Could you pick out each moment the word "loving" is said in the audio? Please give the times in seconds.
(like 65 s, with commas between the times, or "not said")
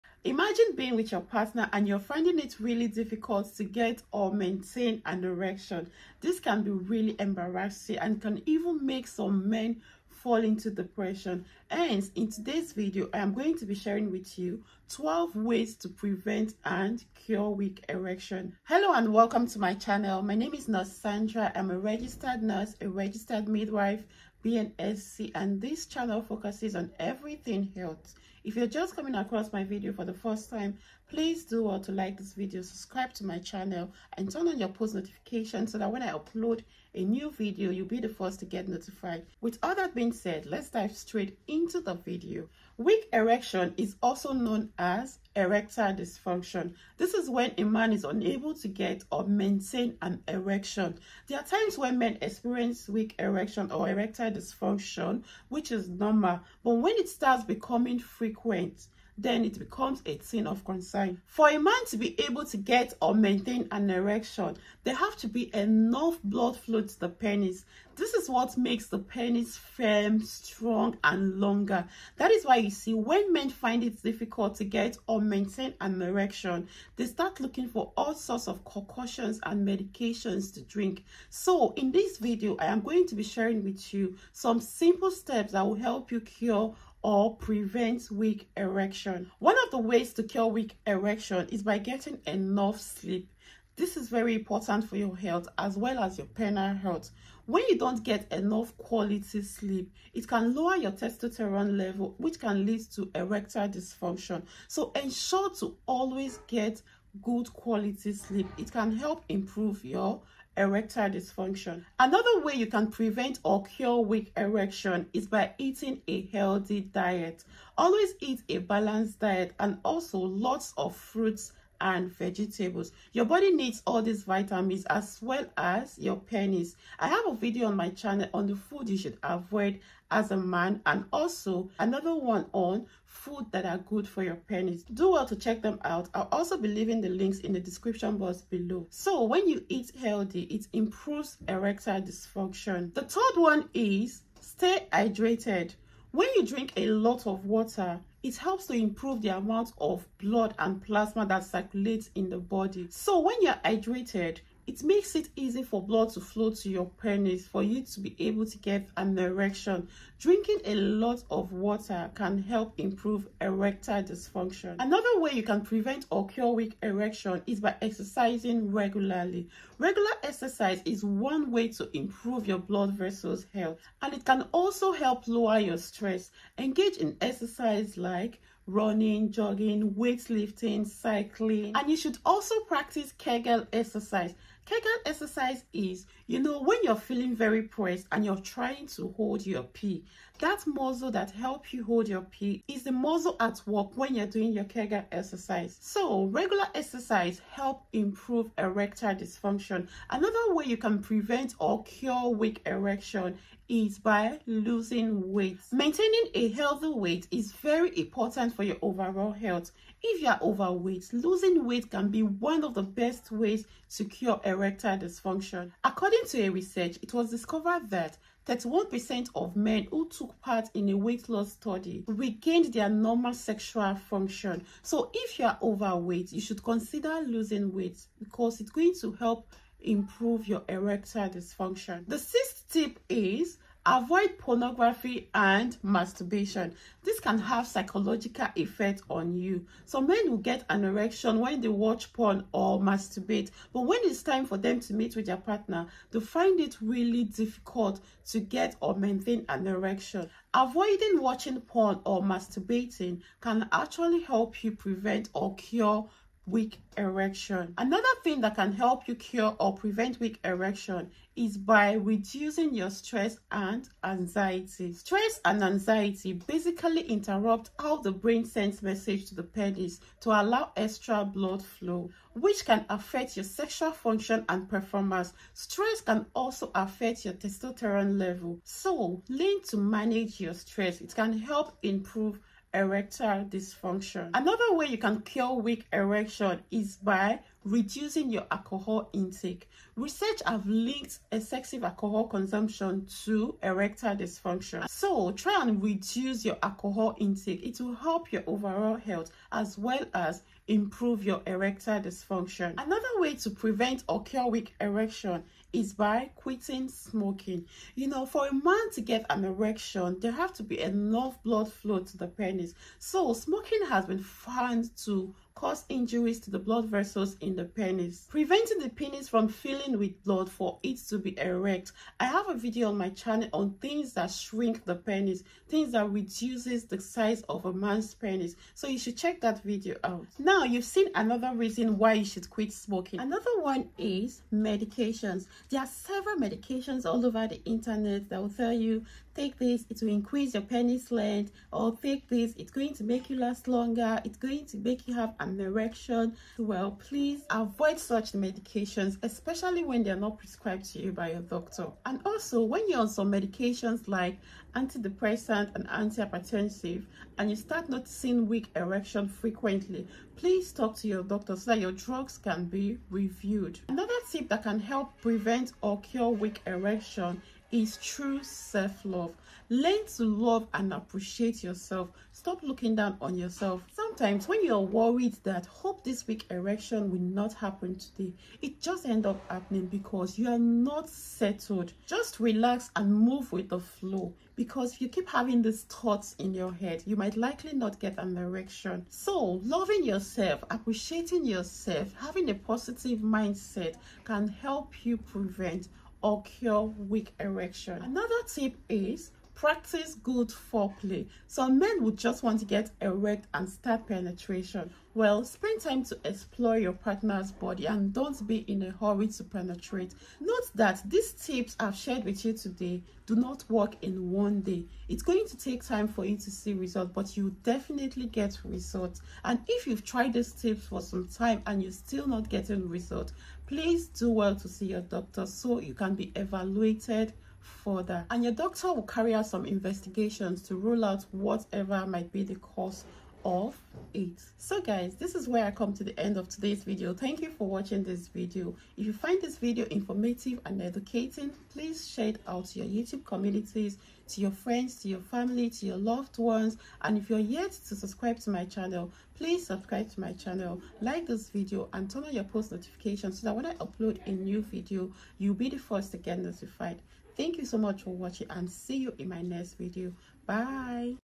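389 s.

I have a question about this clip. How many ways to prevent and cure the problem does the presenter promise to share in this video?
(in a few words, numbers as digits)
12.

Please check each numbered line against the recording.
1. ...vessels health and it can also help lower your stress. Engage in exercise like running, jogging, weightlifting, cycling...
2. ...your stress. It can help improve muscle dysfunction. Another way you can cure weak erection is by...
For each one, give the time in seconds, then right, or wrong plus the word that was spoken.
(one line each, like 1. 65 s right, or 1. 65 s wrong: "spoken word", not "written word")
1. 172 s right
2. 280 s wrong: "erectile", not "muscle".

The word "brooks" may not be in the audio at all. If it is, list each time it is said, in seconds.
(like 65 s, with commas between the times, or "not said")
not said.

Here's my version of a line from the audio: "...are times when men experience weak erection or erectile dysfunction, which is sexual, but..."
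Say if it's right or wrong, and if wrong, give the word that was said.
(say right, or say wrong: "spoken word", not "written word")
wrong: "normal", not "sexual".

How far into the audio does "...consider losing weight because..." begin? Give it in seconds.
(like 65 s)
226 s.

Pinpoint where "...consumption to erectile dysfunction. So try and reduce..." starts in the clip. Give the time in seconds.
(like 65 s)
292 s.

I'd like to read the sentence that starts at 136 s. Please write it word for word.
I'll also be leaving the links in the description box below.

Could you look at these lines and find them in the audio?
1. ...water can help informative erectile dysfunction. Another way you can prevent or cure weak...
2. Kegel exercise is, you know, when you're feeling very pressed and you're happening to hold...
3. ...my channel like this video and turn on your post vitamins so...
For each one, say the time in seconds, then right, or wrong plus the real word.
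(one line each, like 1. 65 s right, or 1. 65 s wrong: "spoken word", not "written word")
1. 161 s wrong: "improve", not "informative"
2. 184 s wrong: "trying", not "happening"
3. 450 s wrong: "notifications", not "vitamins".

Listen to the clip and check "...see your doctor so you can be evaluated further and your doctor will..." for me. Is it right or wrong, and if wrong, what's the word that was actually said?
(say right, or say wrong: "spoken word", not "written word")
right.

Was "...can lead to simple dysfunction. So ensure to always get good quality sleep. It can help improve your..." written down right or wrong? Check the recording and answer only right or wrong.
wrong.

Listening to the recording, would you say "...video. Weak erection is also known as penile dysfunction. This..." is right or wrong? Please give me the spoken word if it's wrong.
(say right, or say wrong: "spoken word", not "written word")
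wrong: "erectile", not "penile".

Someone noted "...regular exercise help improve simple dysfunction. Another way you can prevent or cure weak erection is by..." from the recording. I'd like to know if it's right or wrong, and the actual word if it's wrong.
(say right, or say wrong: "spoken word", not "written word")
wrong: "erectile", not "simple".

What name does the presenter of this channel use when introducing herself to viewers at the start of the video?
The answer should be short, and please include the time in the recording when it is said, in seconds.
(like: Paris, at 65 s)
Nurse Sandra, at 20 s.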